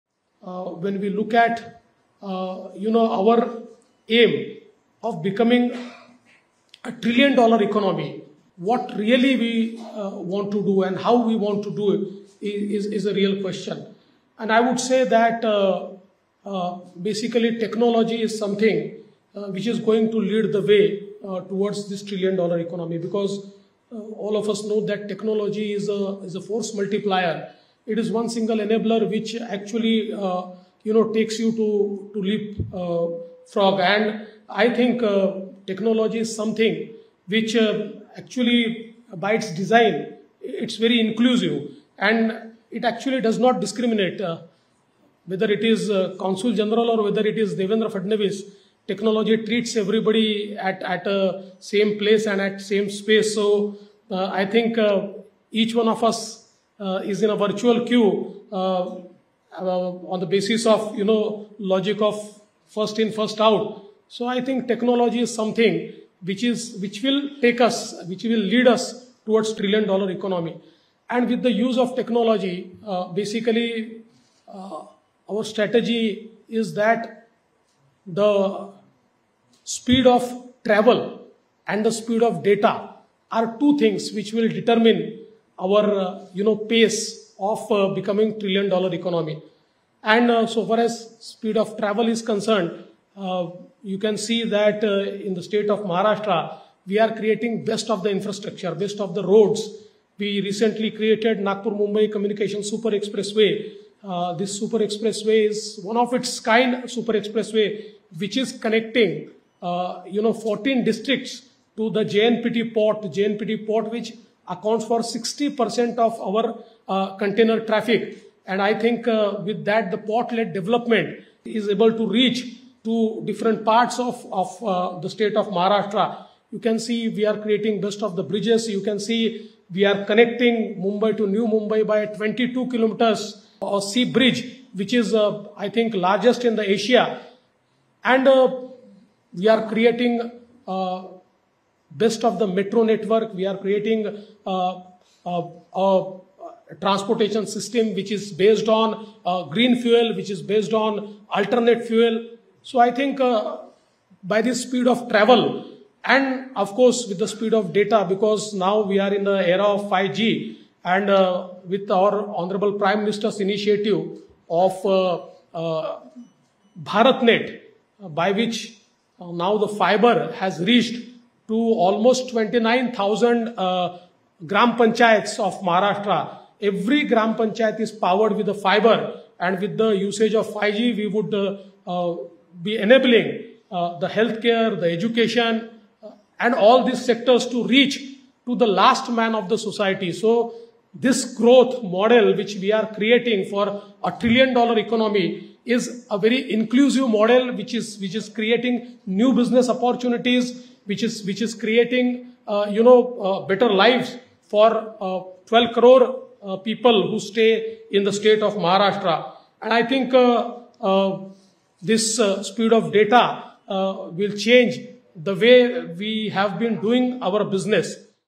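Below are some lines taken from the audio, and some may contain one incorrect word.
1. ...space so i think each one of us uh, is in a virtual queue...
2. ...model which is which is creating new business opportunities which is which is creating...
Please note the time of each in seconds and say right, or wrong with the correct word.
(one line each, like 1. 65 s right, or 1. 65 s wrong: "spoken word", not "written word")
1. 53 s right
2. 197 s right.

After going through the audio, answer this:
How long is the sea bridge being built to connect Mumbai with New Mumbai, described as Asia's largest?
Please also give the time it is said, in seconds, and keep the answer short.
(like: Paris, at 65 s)
22 kilometers, at 132 s.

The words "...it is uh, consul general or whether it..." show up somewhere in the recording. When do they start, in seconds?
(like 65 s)
45 s.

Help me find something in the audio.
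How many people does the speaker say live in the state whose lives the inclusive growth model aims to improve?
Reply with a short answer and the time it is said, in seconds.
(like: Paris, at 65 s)
12 crore, at 205 s.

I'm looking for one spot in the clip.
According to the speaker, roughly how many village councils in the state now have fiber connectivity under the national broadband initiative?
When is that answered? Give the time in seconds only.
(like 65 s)
172 s.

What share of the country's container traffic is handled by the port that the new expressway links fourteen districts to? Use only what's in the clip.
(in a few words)
60%.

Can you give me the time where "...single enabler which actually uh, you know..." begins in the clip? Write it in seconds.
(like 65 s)
28 s.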